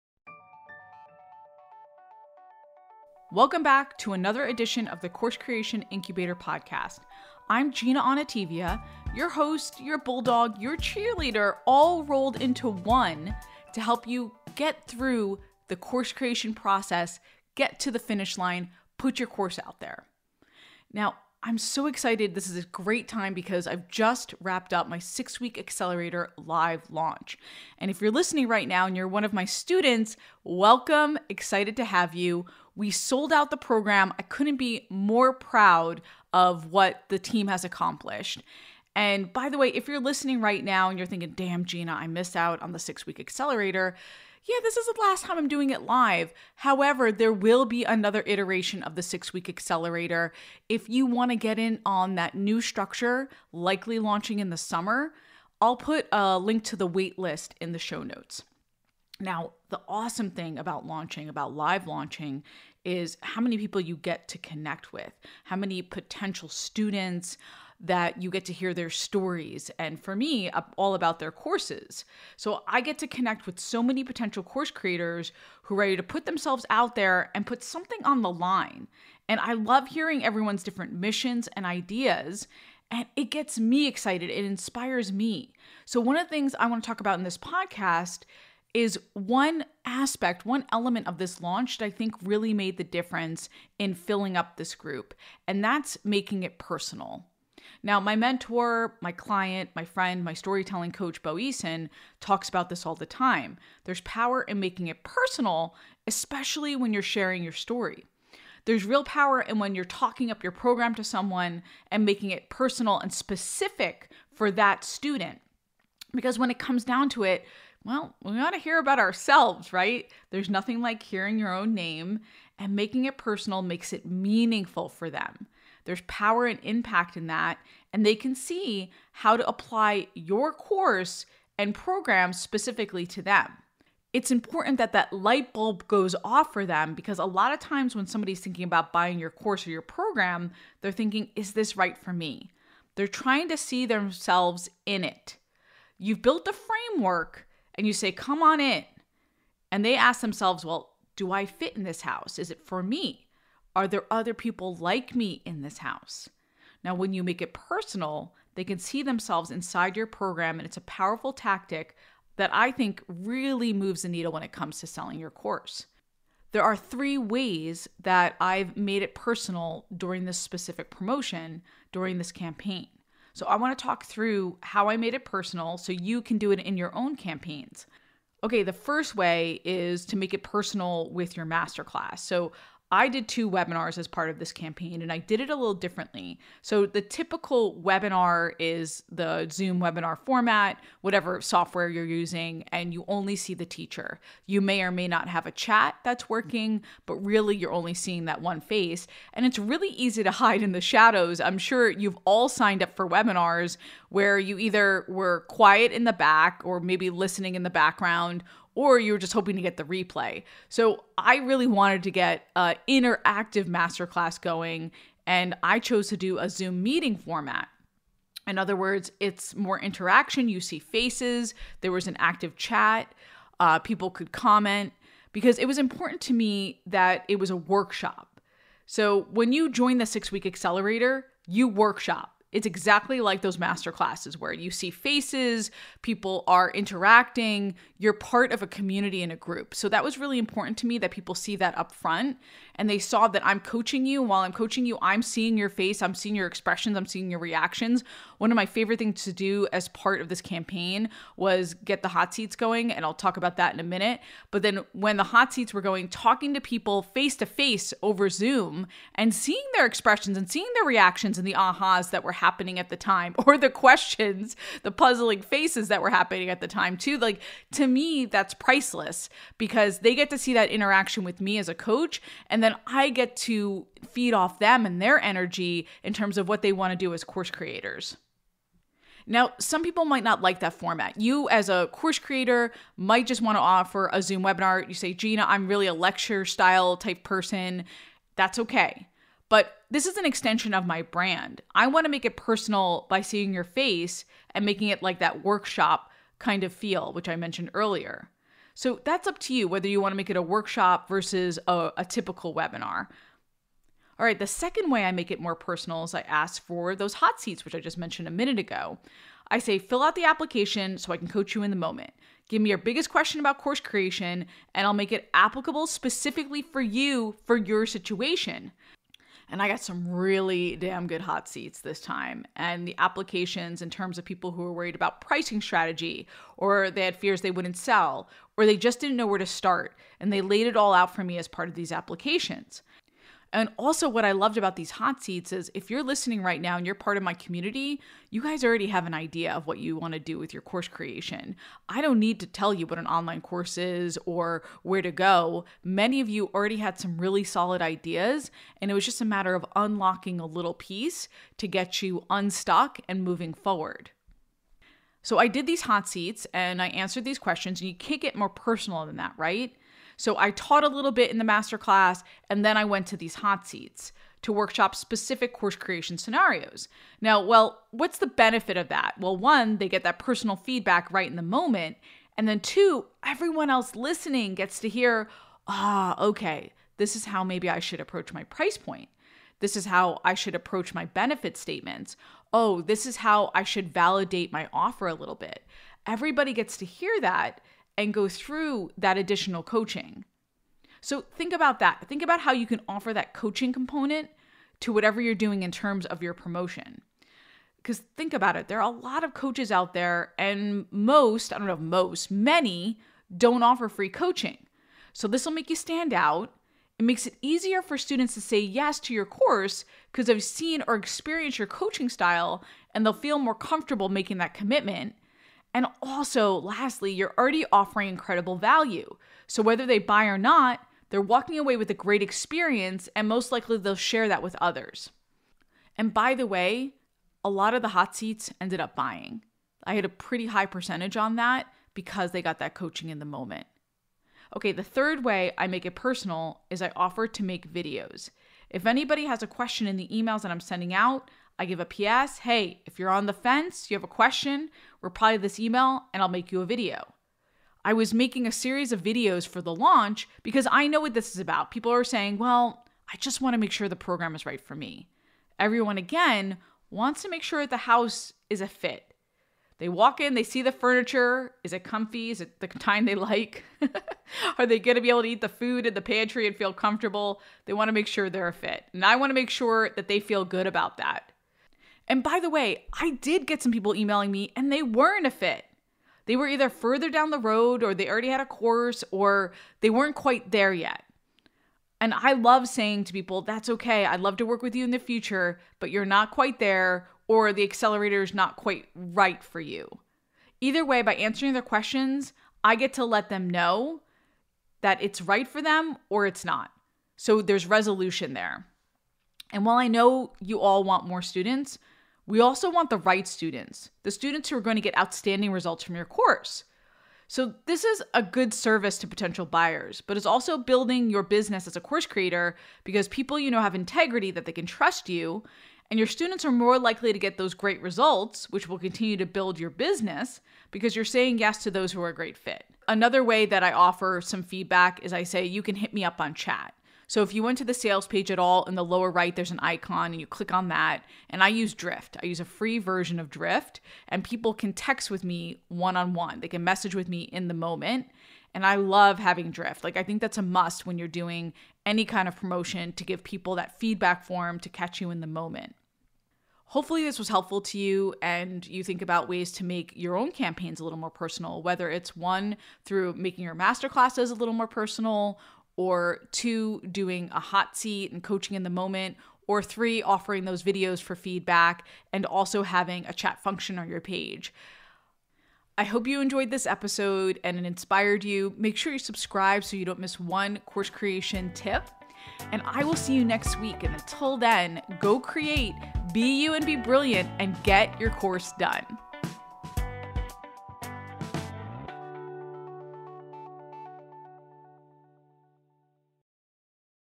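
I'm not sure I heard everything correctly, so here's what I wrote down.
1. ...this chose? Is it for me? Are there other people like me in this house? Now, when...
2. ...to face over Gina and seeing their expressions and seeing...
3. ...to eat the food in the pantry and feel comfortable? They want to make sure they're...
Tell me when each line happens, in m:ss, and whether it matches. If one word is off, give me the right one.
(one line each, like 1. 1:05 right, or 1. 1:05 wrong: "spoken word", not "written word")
1. 2:31 wrong: "house", not "chose"
2. 4:17 wrong: "Zoom", not "Gina"
3. 7:45 right.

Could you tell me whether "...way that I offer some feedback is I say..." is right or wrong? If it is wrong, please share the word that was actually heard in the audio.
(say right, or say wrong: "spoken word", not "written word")
right.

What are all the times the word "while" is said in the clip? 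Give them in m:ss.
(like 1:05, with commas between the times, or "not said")
4:04, 8:19.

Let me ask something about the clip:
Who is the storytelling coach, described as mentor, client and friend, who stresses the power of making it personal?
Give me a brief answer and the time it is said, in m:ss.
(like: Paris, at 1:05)
Bo Eason, at 1:41.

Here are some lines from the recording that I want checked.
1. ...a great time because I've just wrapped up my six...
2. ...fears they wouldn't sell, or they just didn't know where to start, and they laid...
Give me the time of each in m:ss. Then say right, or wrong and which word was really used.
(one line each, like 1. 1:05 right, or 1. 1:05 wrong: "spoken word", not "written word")
1. 0:22 right
2. 5:27 right.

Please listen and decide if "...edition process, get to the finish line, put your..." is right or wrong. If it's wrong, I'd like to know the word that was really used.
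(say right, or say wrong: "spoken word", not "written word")
wrong: "creation", not "edition".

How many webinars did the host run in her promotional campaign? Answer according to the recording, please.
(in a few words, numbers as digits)
2.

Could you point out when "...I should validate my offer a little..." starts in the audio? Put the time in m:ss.
6:23.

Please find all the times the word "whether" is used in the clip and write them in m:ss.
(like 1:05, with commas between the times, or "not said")
4:59, 6:59, 9:11.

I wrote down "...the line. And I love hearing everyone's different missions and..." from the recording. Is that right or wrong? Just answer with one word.
right.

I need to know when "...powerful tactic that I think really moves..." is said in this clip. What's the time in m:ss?
2:40.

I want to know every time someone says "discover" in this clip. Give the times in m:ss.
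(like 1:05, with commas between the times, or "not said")
not said.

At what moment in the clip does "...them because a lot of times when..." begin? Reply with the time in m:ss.
2:16.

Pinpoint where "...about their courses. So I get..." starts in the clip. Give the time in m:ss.
1:10.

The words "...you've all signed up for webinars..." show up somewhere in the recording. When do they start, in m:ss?
3:21.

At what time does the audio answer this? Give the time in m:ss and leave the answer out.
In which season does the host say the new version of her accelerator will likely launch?
0:54.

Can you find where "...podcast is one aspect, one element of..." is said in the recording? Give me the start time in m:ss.
1:27.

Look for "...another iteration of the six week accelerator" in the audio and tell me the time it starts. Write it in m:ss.
0:47.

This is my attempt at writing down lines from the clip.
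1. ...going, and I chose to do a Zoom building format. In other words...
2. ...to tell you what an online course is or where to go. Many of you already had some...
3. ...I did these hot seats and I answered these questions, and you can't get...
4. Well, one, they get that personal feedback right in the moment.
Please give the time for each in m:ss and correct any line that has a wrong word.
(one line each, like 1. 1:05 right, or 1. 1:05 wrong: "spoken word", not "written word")
1. 3:34 wrong: "meeting", not "building"
2. 5:42 right
3. 5:55 right
4. 6:09 right.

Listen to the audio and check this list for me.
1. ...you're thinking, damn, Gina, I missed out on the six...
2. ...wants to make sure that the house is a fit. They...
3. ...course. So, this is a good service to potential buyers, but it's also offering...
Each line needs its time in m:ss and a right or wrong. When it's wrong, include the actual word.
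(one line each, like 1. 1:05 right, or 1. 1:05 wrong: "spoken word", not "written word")
1. 0:40 right
2. 7:36 right
3. 8:26 wrong: "building", not "offering".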